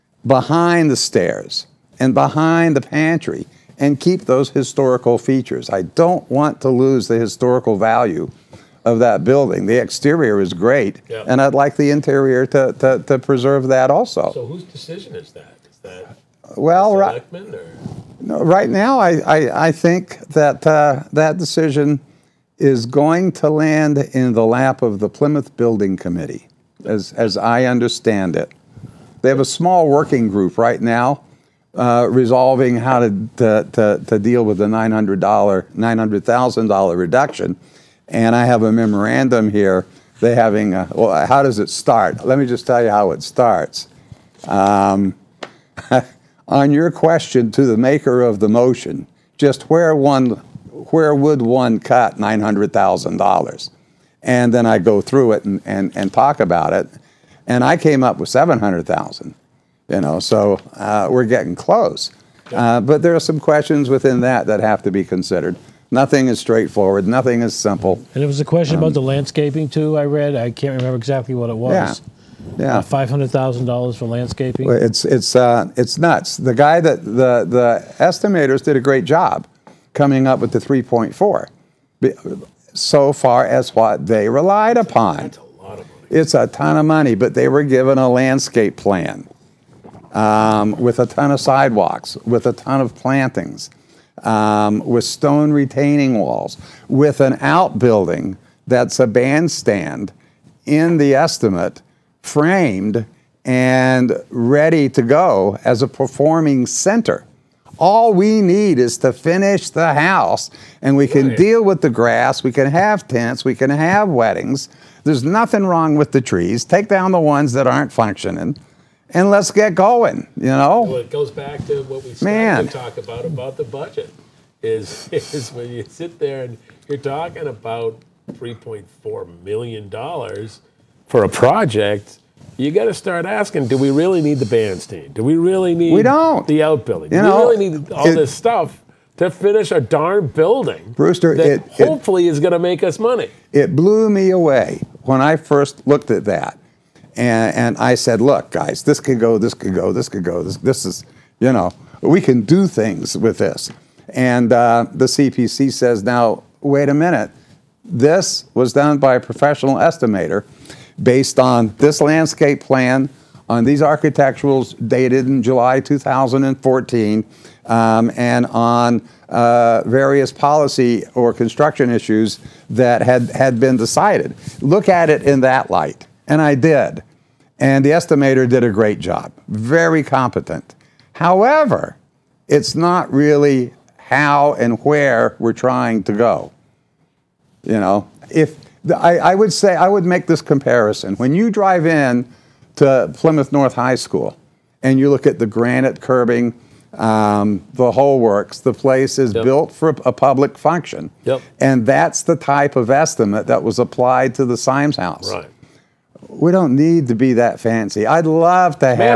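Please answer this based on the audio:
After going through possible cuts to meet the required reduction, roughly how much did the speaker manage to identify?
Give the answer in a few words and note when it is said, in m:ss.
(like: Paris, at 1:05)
$700,000, at 0:58.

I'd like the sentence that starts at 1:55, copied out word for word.
There's nothing wrong with the trees.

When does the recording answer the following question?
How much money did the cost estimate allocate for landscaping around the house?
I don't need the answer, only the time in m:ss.
1:12.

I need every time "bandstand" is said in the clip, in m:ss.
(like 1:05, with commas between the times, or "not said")
1:39, 2:14.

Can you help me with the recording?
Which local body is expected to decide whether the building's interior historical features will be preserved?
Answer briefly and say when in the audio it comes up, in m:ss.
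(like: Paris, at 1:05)
Plymouth Building Committee, at 0:25.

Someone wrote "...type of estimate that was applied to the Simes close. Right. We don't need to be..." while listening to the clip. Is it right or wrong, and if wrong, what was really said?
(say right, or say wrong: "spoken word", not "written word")
wrong: "house", not "close".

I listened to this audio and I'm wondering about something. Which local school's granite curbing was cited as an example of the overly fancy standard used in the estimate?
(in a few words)
Plymouth North High School.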